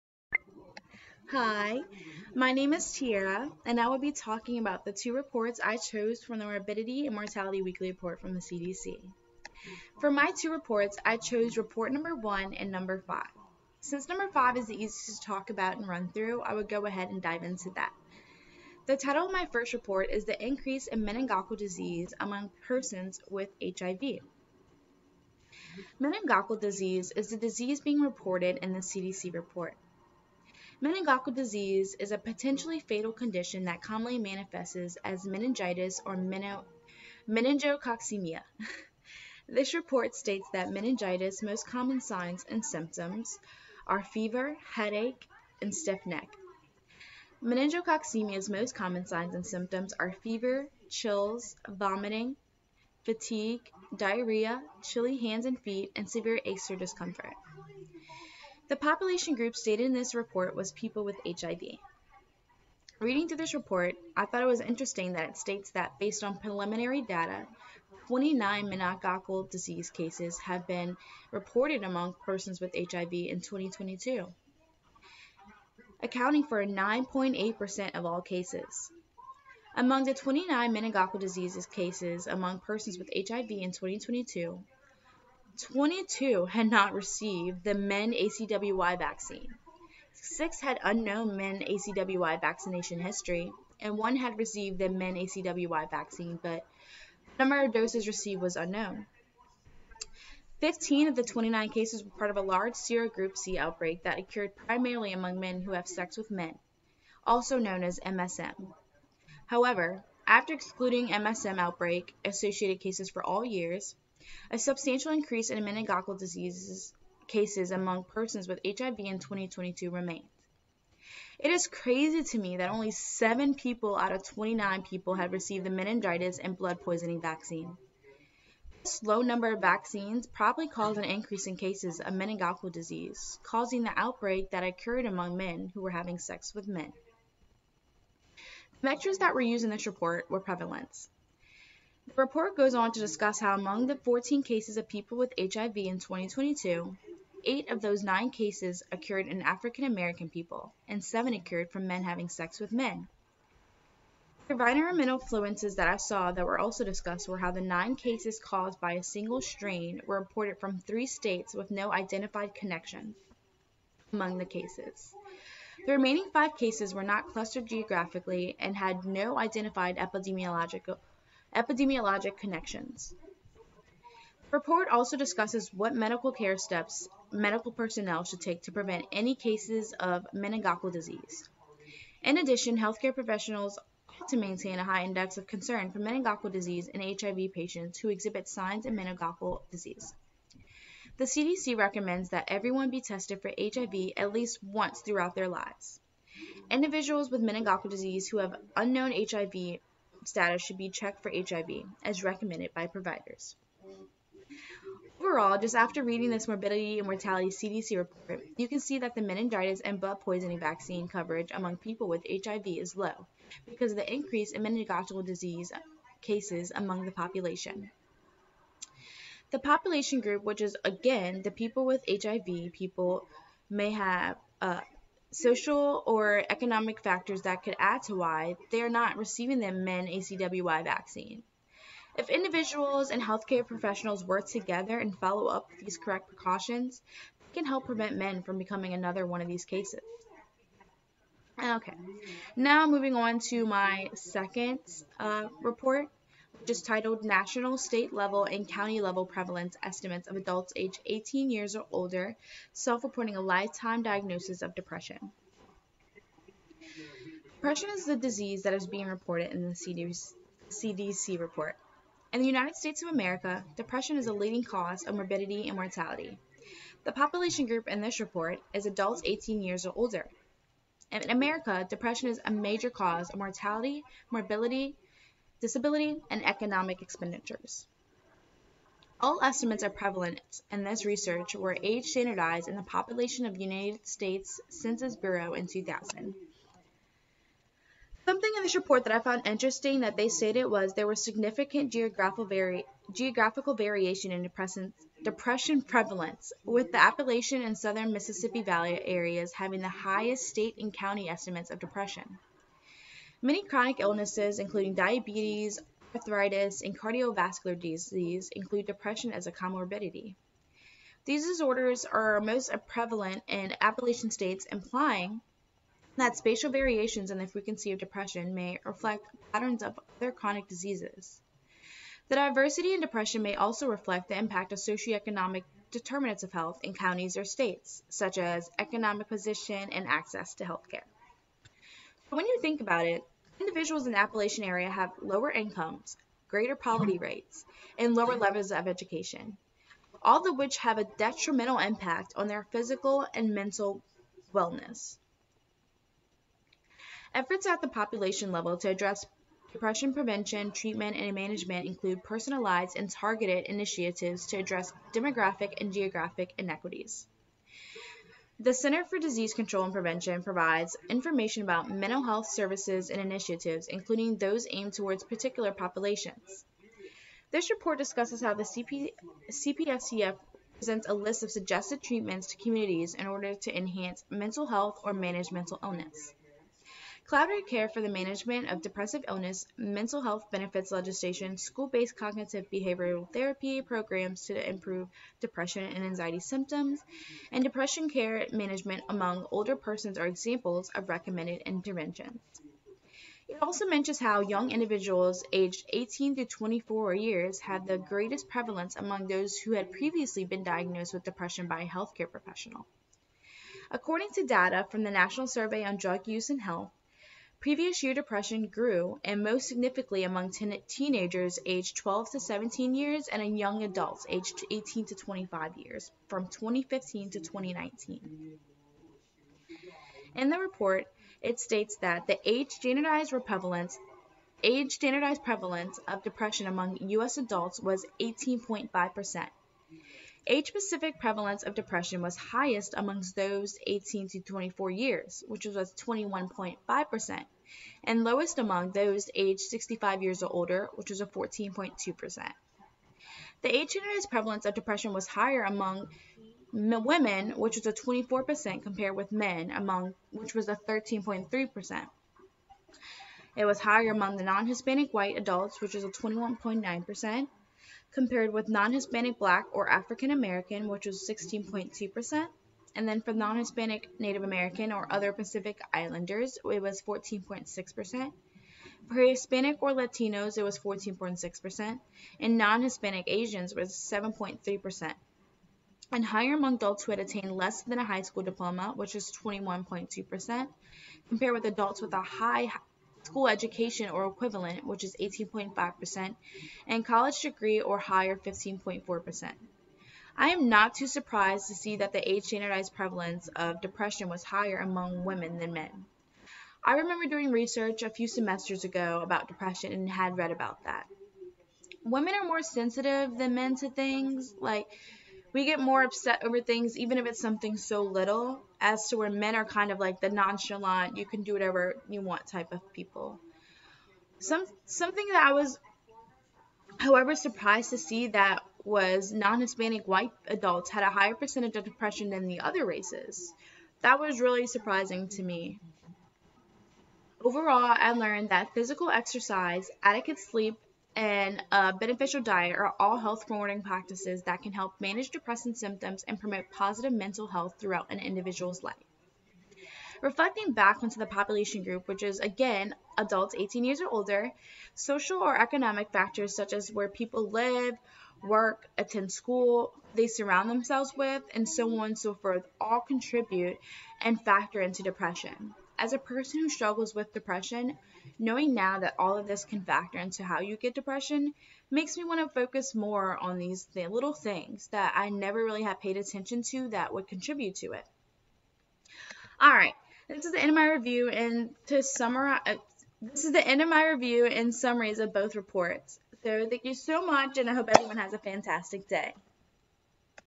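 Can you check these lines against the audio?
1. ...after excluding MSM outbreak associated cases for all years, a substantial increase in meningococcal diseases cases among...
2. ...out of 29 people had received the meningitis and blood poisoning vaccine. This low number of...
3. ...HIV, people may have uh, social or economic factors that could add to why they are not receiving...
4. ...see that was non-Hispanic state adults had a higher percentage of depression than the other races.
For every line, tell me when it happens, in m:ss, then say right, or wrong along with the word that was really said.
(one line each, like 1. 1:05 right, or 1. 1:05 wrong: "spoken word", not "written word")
1. 1:50 right
2. 2:03 right
3. 3:42 right
4. 8:37 wrong: "white", not "state".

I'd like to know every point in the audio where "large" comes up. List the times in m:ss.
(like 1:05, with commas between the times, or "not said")
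1:42.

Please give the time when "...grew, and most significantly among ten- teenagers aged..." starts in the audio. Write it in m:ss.
6:48.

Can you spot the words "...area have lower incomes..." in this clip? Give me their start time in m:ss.
5:34.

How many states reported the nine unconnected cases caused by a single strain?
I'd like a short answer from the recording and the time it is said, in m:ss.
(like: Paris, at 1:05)
3, at 2:40.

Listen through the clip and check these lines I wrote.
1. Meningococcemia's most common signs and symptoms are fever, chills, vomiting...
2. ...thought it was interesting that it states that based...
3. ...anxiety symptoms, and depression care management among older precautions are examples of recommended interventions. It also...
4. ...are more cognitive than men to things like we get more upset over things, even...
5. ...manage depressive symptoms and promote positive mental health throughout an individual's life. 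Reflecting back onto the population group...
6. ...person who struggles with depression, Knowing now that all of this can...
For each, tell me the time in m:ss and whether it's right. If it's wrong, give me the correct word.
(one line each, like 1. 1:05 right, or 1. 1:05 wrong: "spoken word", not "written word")
1. 0:47 right
2. 1:04 right
3. 6:26 wrong: "persons", not "precautions"
4. 8:22 wrong: "sensitive", not "cognitive"
5. 8:55 right
6. 9:16 right.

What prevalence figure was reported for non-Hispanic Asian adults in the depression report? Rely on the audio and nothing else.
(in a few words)
7.3%.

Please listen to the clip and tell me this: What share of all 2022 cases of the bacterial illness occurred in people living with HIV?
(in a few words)
9.8%.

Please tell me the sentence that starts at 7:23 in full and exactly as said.
The age-generalized prevalence of depression was higher among women, which was a 24% compared with men, among which was a 13.3%.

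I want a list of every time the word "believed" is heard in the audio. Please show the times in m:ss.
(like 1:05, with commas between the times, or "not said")
not said.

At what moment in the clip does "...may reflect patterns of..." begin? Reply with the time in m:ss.
5:18.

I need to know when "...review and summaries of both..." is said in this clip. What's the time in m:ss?
9:34.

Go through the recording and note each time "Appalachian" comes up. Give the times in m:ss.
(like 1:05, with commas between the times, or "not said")
4:57, 5:13, 5:34.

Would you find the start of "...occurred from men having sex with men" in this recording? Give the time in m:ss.
2:31.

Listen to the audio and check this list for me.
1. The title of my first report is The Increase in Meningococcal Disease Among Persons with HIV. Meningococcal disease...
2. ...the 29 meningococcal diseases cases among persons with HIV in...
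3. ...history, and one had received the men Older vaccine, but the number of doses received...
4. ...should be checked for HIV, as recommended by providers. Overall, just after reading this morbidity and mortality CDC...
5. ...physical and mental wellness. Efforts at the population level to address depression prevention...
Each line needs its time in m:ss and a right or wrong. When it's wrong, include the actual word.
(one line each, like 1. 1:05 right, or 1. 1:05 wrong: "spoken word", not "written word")
1. 0:18 right
2. 1:20 right
3. 1:33 wrong: "ACWY", not "Older"
4. 3:20 right
5. 5:42 right.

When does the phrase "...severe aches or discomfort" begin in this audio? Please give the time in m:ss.
0:56.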